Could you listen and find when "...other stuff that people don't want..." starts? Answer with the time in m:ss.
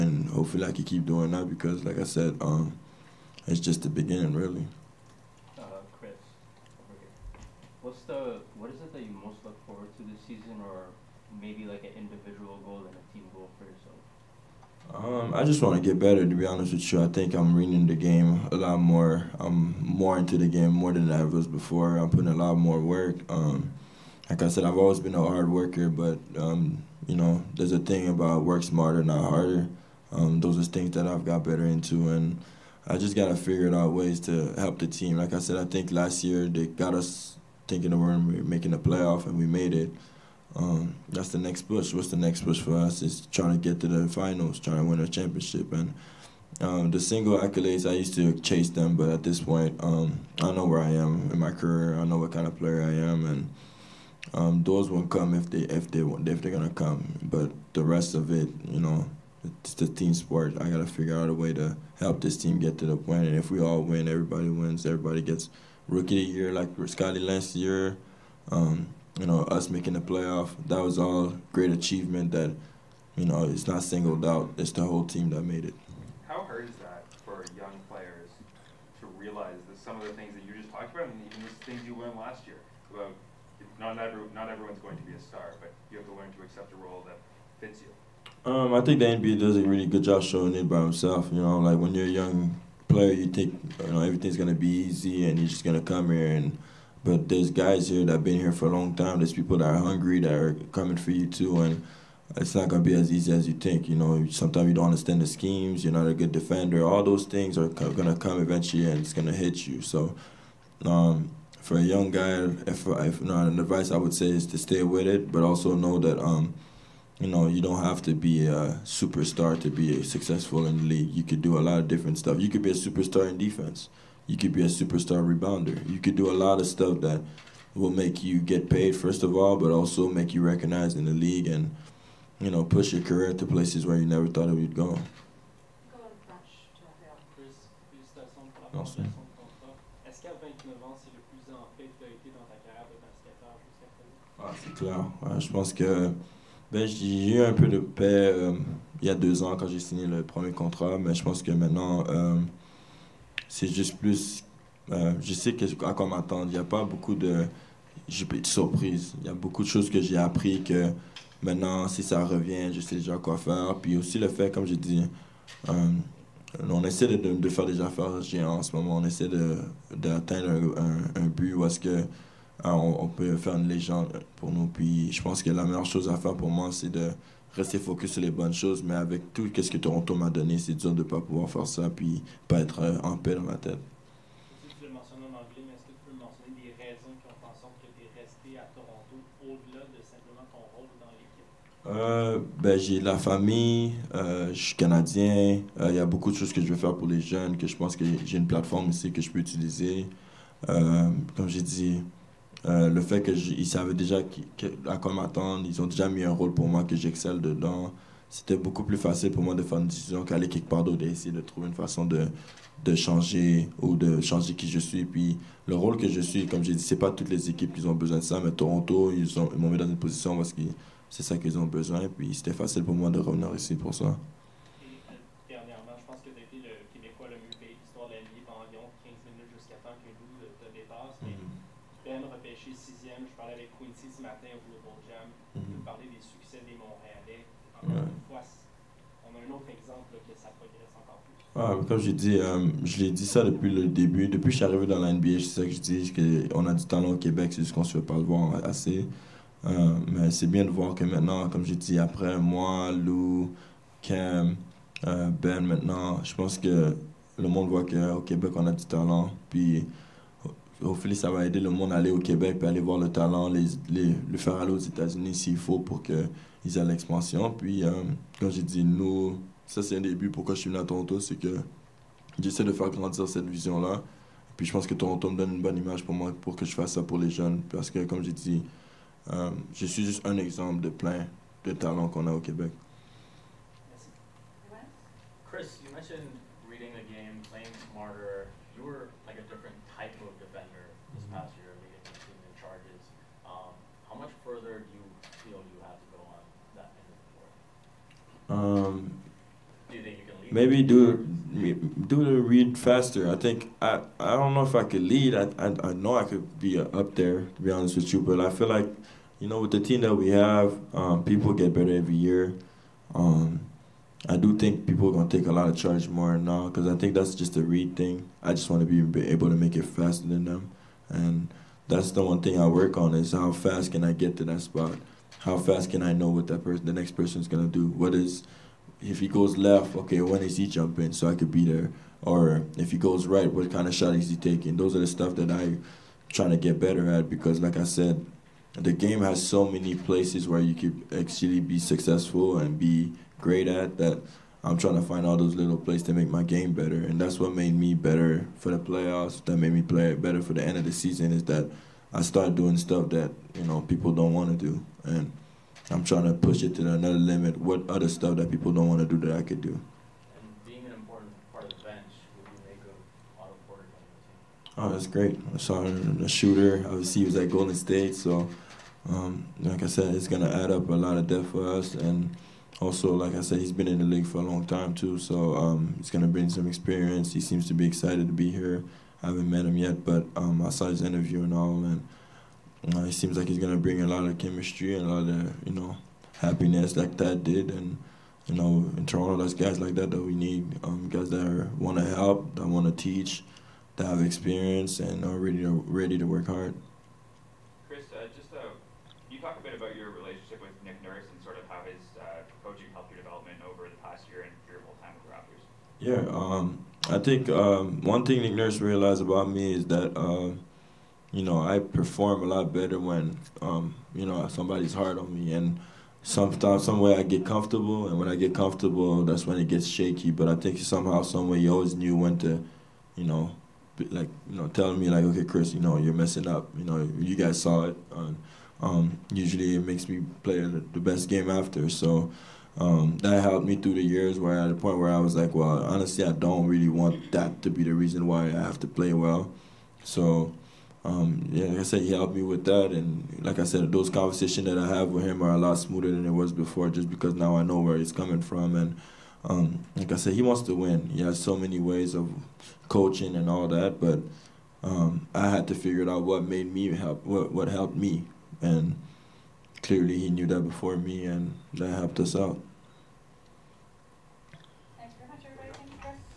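5:57.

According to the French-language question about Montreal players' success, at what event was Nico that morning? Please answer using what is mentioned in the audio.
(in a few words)
Global Jam.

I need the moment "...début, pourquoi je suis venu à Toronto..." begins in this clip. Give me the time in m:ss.
4:30.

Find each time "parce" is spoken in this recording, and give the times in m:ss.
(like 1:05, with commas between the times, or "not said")
3:40, 4:37.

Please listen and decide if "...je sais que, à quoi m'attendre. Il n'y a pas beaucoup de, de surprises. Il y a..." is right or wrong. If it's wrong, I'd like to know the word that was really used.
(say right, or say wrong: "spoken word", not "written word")
right.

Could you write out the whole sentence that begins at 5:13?
Um, I do think people are gonna take a lot of charge more now because I think that's just a read thing.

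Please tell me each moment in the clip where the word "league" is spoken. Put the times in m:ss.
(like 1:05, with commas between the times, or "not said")
2:00, 2:11, 6:14.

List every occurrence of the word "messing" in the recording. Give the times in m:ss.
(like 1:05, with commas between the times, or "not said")
7:06.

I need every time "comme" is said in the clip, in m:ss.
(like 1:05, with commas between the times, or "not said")
2:44, 3:20, 3:36, 4:01, 4:11, 4:38.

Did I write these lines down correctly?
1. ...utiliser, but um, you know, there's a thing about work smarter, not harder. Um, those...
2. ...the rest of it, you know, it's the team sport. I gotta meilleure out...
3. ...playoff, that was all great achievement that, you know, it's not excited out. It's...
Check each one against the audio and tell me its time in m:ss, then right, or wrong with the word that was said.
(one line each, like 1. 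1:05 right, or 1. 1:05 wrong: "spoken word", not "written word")
1. 0:25 wrong: "worker", not "utiliser"
2. 0:57 wrong: "figure", not "meilleure"
3. 1:10 wrong: "singled", not "excited".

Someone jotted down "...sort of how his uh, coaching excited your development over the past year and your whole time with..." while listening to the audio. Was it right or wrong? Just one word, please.
wrong.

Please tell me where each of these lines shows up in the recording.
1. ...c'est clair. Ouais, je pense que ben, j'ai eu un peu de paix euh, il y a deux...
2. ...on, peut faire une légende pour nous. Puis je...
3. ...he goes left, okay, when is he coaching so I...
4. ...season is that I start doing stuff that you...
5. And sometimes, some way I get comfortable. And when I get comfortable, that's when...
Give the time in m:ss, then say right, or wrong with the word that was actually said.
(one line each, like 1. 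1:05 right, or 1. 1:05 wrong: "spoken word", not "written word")
1. 2:24 right
2. 2:52 right
3. 5:29 wrong: "jumping", not "coaching"
4. 5:50 right
5. 6:55 right.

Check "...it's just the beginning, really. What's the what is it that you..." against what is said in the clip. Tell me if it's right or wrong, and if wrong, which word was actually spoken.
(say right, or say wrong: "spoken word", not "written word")
right.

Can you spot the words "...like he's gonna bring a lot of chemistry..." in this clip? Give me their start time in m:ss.
6:23.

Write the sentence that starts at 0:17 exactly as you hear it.
I think I'm reading the game a lot more.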